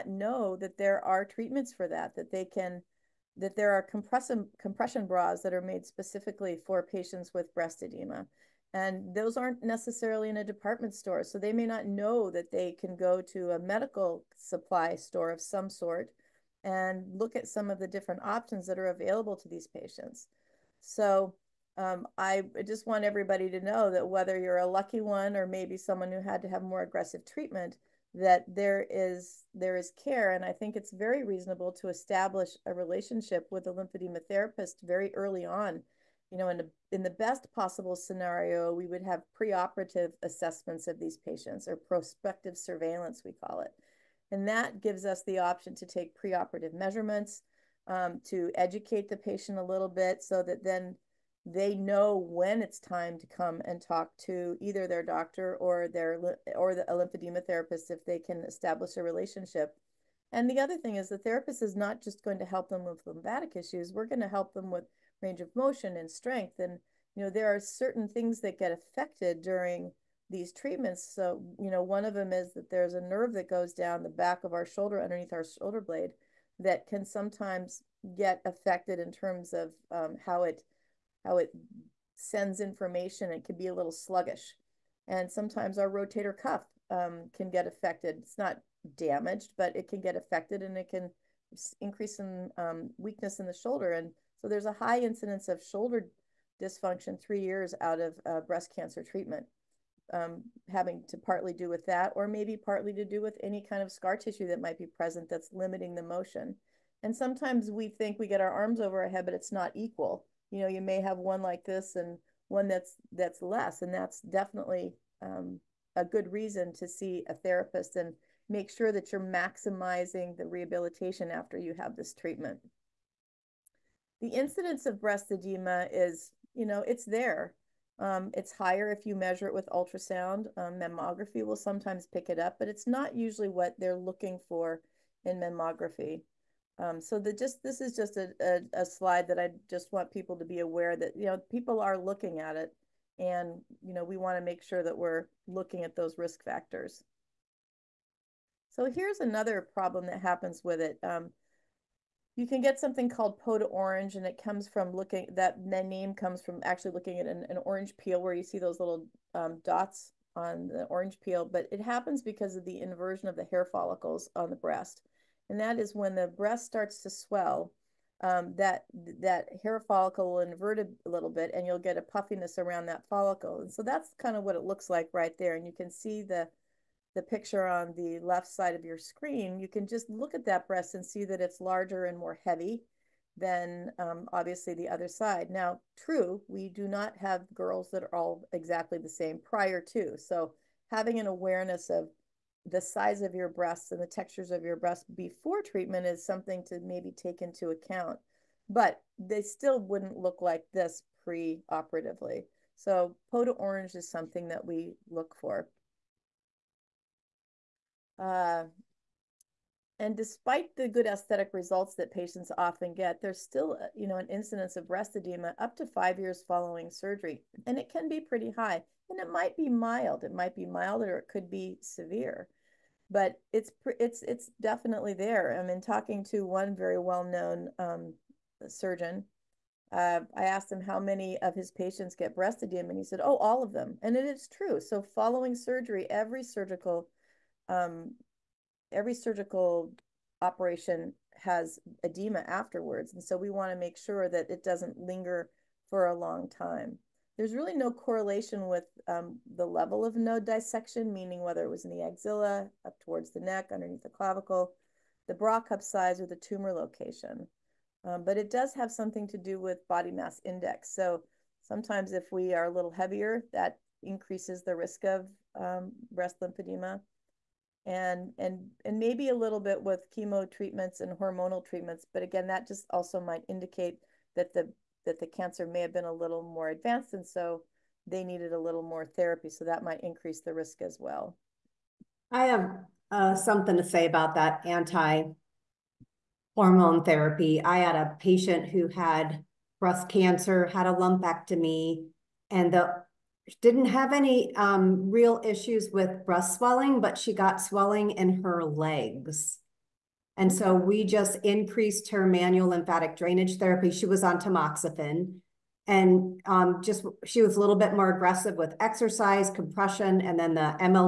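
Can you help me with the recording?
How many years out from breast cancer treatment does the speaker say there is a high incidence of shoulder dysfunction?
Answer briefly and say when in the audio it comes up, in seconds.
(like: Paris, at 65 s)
3, at 97 s.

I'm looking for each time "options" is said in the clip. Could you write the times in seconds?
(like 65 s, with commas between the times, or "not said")
18 s, 45 s.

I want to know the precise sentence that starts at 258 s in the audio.
Um, but it does have something to do with body mass index.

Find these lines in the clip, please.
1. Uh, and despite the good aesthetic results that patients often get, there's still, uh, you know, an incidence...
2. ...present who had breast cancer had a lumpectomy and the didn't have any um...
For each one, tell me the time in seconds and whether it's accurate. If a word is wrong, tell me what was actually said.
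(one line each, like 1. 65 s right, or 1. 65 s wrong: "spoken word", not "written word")
1. 208 s right
2. 288 s wrong: "patient", not "present".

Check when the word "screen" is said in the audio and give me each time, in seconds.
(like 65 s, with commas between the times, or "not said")
178 s.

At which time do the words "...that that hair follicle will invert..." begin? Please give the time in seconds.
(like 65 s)
168 s.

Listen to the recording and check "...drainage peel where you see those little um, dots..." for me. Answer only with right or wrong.
wrong.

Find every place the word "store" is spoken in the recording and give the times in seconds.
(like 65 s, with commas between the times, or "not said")
10 s, 14 s.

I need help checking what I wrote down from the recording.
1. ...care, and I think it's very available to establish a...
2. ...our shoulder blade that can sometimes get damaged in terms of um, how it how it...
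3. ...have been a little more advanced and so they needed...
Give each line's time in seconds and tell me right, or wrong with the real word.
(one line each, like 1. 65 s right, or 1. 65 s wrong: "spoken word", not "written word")
1. 30 s wrong: "reasonable", not "available"
2. 75 s wrong: "affected", not "damaged"
3. 275 s right.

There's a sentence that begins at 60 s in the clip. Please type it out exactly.
And the other thing is the therapist is not just going to help them with lymphatic issues.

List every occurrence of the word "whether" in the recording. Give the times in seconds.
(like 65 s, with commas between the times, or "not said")
24 s, 251 s.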